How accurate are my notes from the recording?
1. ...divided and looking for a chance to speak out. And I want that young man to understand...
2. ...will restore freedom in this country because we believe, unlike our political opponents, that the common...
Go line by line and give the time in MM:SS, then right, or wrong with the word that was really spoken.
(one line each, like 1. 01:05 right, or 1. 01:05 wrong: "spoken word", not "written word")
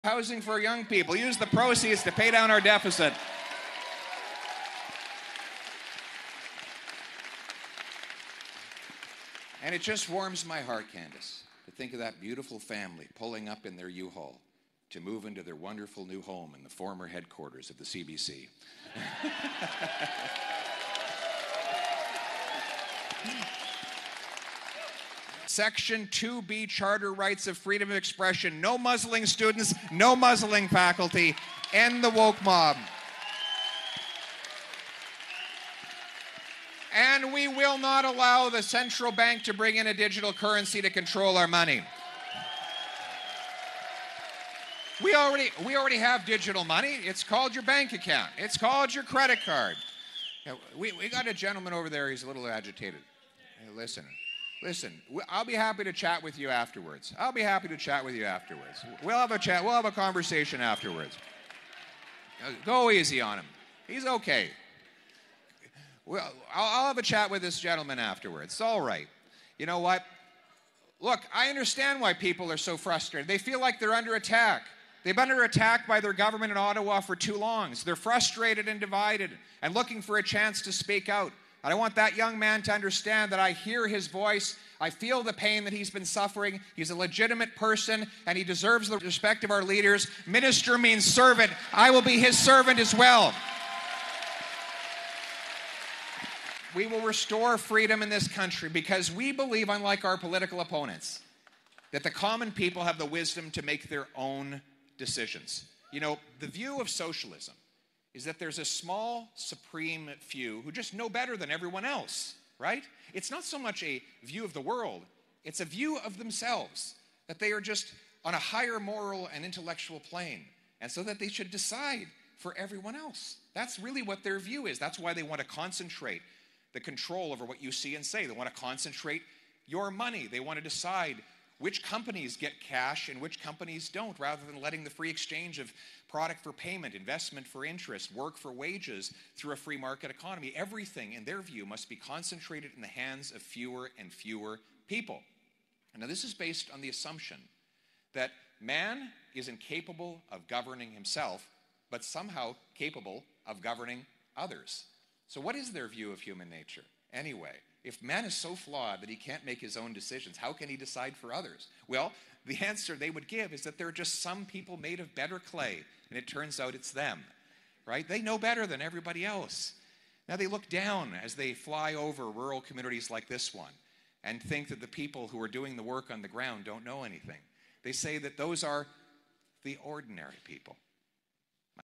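1. 01:18 right
2. 01:36 right.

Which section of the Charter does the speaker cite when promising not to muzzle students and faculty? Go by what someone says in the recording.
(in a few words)
Section 2B.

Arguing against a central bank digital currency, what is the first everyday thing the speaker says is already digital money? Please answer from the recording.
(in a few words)
your bank account.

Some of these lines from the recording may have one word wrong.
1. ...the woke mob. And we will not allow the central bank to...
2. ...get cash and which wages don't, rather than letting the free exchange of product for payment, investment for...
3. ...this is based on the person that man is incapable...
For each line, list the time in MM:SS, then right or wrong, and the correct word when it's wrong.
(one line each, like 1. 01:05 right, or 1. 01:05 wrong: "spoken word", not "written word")
1. 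00:32 right
2. 02:12 wrong: "companies", not "wages"
3. 02:26 wrong: "assumption", not "person".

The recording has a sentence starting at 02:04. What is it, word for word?
That's why they want to concentrate the control over what you see and say.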